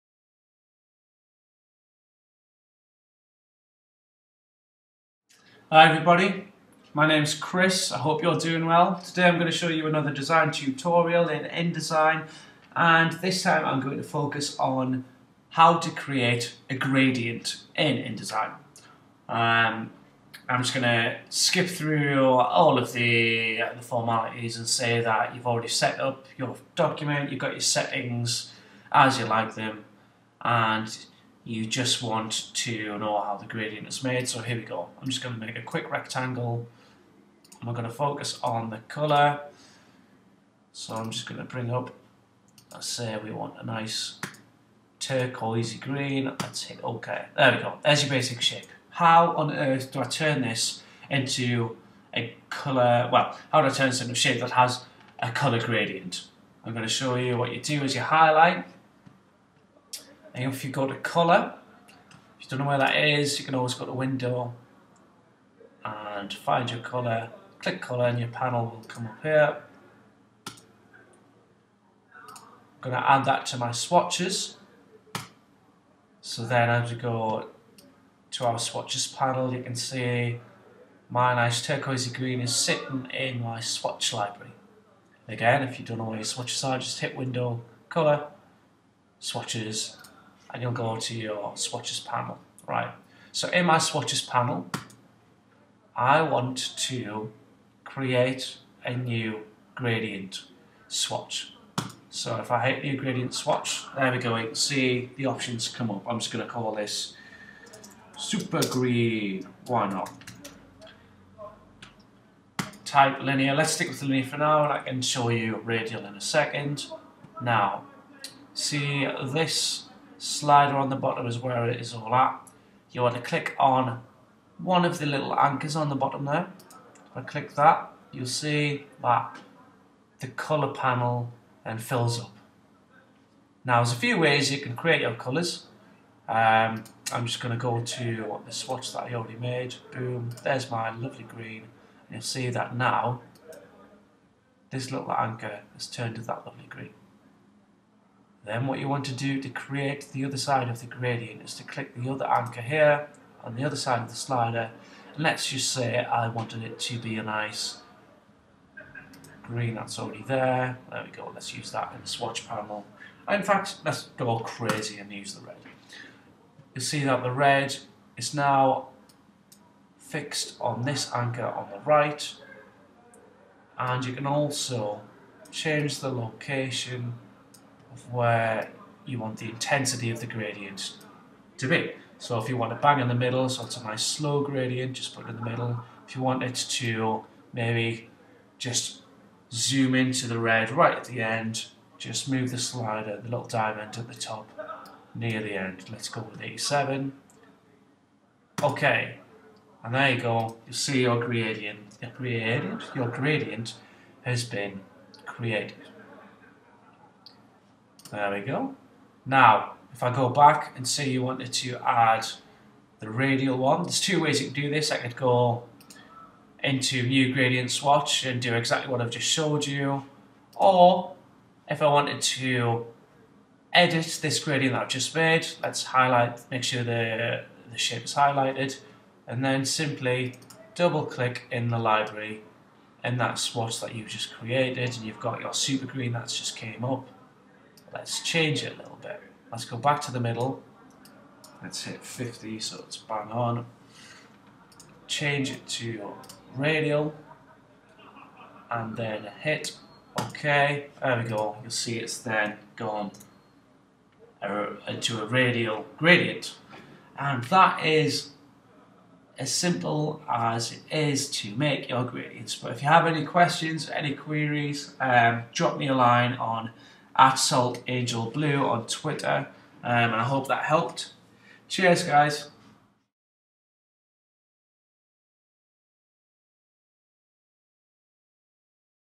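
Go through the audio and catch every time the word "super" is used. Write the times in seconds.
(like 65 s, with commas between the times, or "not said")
108 s, 235 s.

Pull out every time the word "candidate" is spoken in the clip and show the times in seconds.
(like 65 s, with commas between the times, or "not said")
not said.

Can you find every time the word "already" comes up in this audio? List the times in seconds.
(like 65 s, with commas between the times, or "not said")
25 s, 139 s, 159 s.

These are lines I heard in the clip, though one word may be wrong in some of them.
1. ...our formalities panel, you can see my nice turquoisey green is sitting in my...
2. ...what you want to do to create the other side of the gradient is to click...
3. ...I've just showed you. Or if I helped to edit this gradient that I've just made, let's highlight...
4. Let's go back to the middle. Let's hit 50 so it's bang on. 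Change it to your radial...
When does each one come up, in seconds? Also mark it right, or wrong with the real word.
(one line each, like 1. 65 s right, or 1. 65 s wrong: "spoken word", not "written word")
1. 78 s wrong: "swatches", not "formalities"
2. 148 s right
3. 218 s wrong: "wanted", not "helped"
4. 239 s right.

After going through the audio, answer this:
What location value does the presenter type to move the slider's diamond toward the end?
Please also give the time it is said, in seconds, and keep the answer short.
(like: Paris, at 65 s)
87, at 196 s.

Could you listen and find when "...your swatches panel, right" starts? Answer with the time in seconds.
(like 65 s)
91 s.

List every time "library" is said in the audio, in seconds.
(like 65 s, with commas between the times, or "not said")
84 s, 231 s.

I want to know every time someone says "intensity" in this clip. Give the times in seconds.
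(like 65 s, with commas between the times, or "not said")
179 s.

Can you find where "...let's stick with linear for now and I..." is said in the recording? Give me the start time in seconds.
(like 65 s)
113 s.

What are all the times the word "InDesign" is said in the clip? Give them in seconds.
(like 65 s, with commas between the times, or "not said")
11 s, 17 s.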